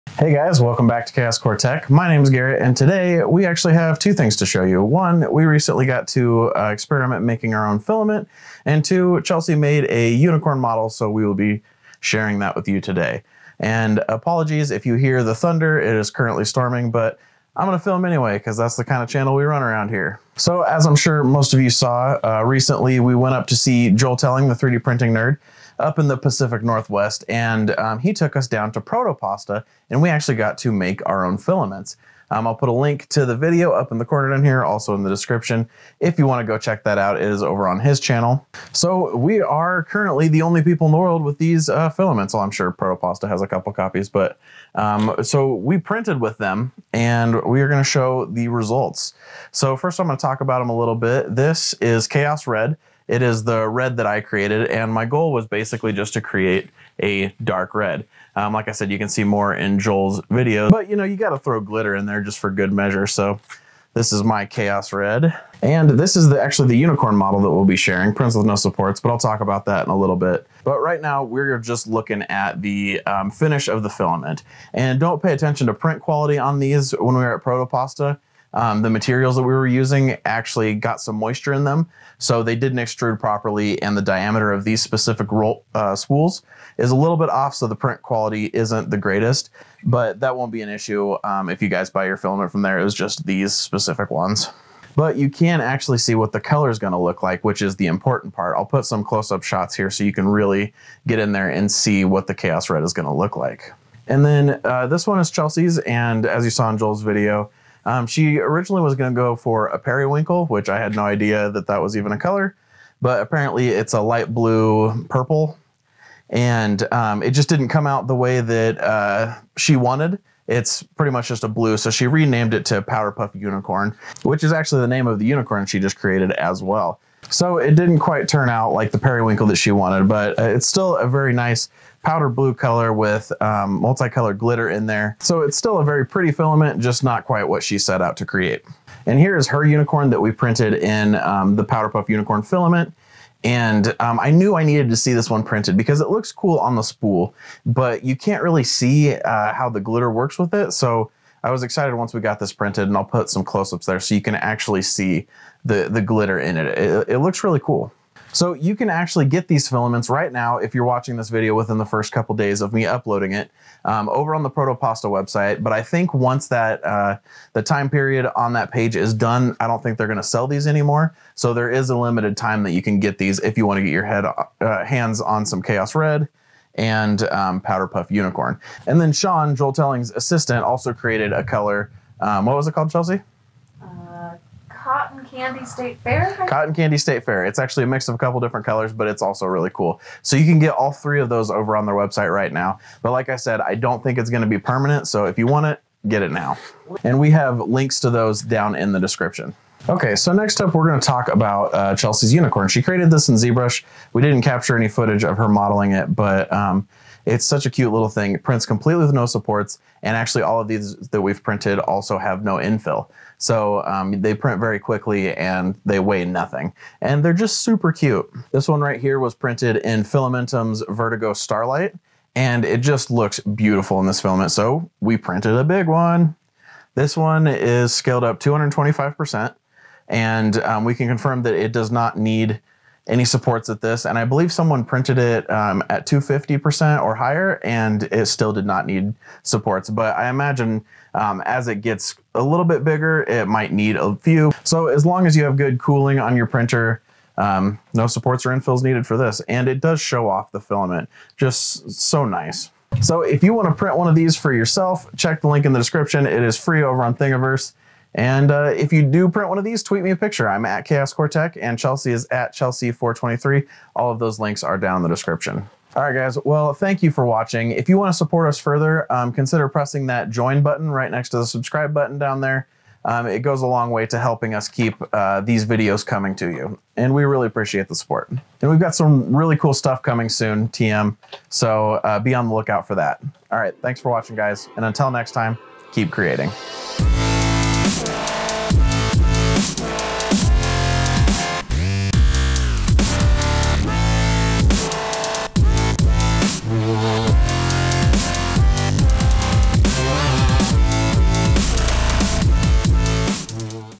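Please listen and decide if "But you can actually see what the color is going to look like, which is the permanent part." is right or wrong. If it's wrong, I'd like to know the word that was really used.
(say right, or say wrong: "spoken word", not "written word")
wrong: "important", not "permanent".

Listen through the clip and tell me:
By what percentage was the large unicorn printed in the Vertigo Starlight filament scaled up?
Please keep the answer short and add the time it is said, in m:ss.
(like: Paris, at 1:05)
225%, at 3:48.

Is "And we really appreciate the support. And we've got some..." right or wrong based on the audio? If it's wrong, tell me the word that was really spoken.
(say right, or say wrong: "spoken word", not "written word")
right.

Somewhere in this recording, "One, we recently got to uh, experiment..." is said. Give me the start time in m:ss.
0:04.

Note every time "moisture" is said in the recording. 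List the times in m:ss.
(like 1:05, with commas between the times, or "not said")
1:21.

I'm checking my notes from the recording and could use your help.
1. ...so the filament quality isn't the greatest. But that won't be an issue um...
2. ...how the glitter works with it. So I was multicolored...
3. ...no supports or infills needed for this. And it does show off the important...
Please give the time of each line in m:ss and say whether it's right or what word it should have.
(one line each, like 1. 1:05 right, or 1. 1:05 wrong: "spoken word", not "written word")
1. 1:27 wrong: "print", not "filament"
2. 2:29 wrong: "excited", not "multicolored"
3. 4:07 wrong: "filament", not "important".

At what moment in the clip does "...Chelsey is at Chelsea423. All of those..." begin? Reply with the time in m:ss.
4:21.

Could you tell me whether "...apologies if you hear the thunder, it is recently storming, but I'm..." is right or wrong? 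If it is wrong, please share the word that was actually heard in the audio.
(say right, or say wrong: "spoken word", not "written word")
wrong: "currently", not "recently".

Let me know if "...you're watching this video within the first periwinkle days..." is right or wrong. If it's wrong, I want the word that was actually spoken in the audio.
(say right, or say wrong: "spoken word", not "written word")
wrong: "couple", not "periwinkle".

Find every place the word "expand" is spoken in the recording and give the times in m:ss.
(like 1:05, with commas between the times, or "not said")
not said.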